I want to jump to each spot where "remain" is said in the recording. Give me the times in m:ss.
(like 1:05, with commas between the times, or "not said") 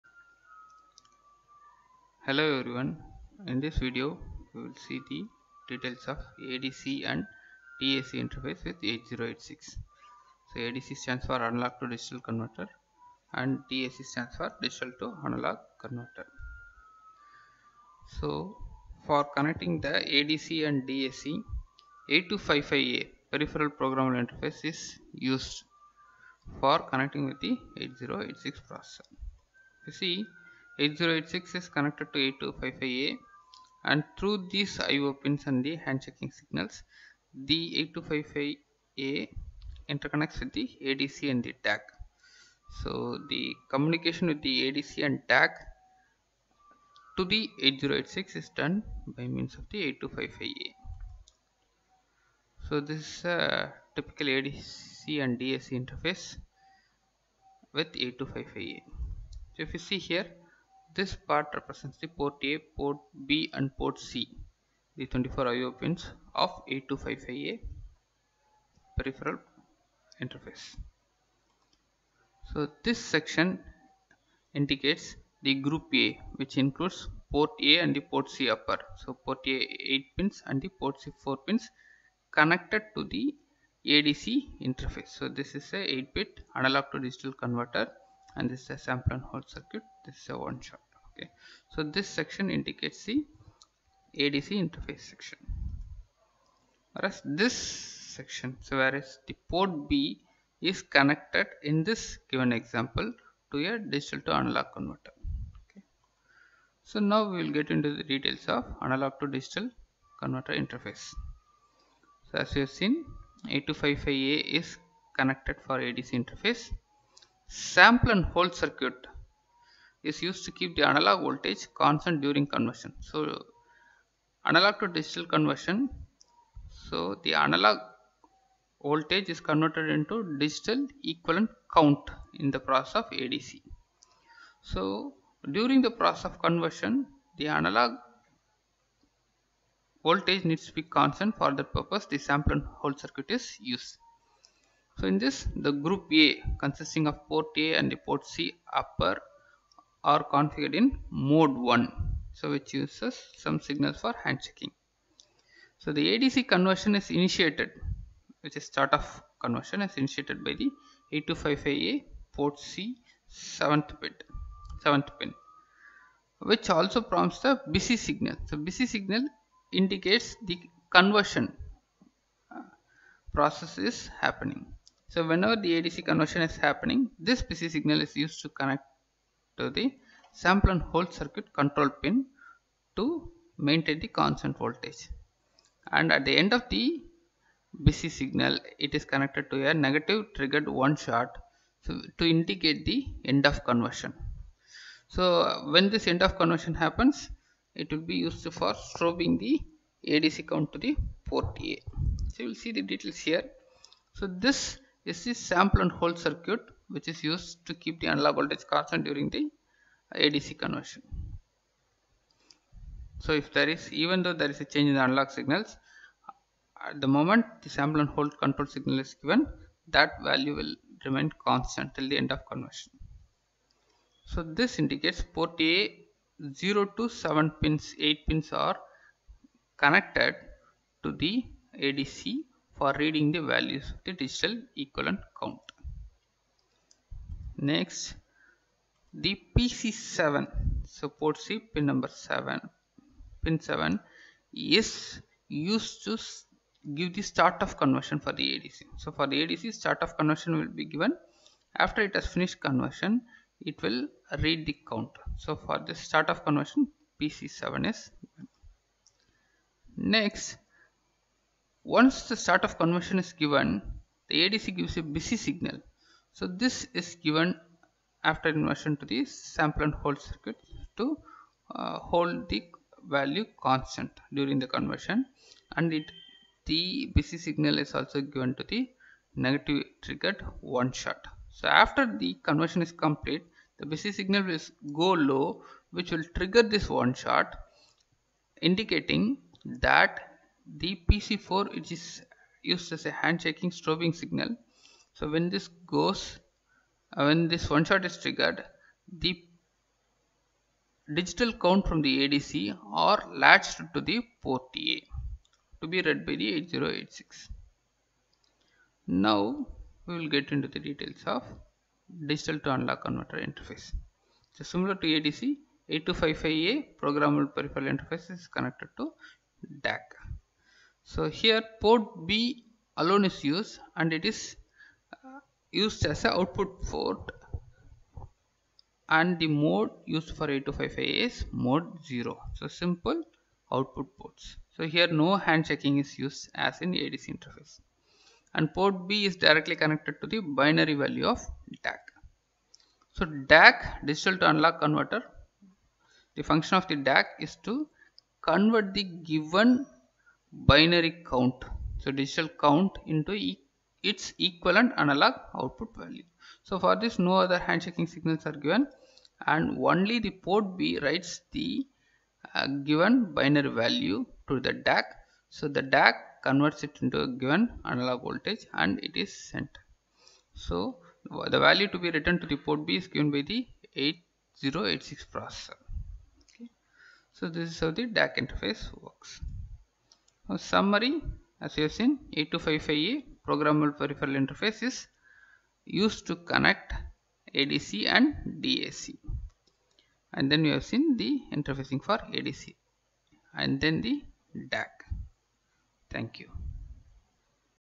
3:41.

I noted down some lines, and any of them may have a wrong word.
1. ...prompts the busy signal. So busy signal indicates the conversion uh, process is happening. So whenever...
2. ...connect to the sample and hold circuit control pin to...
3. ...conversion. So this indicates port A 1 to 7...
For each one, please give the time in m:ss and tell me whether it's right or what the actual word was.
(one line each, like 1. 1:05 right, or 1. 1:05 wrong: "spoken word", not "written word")
1. 2:47 right
2. 2:58 right
3. 3:42 wrong: "0", not "1".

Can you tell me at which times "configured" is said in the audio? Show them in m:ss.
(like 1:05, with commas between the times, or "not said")
2:30.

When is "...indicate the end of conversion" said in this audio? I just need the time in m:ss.
3:12.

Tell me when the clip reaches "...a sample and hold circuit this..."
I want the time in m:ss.
1:28.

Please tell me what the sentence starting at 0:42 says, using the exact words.
So the communication with the ADC and DAC to the 8086 is done by means of the 8255A.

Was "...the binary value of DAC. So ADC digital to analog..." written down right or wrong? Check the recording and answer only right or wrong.
wrong.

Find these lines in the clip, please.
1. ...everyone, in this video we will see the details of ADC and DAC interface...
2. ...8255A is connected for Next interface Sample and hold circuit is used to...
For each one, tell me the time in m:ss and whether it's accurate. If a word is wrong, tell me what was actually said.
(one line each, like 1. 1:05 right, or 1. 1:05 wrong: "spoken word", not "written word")
1. 0:02 right
2. 1:53 wrong: "ADC", not "Next".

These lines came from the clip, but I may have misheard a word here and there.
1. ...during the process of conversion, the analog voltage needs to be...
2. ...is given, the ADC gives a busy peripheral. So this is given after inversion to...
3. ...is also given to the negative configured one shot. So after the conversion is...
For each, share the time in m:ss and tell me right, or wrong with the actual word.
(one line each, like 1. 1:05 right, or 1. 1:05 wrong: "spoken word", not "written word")
1. 2:15 right
2. 4:23 wrong: "signal", not "peripheral"
3. 4:37 wrong: "triggered", not "configured".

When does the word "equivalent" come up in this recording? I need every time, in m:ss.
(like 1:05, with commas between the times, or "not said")
2:11, 3:54, 5:54.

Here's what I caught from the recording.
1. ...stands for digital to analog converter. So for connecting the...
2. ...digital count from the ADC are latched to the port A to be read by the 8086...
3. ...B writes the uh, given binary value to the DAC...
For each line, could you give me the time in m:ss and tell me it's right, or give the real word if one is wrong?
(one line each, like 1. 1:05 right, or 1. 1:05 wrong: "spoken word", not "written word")
1. 0:14 right
2. 5:01 right
3. 6:00 right.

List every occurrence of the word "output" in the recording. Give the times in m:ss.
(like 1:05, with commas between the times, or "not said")
5:26, 5:33, 5:55.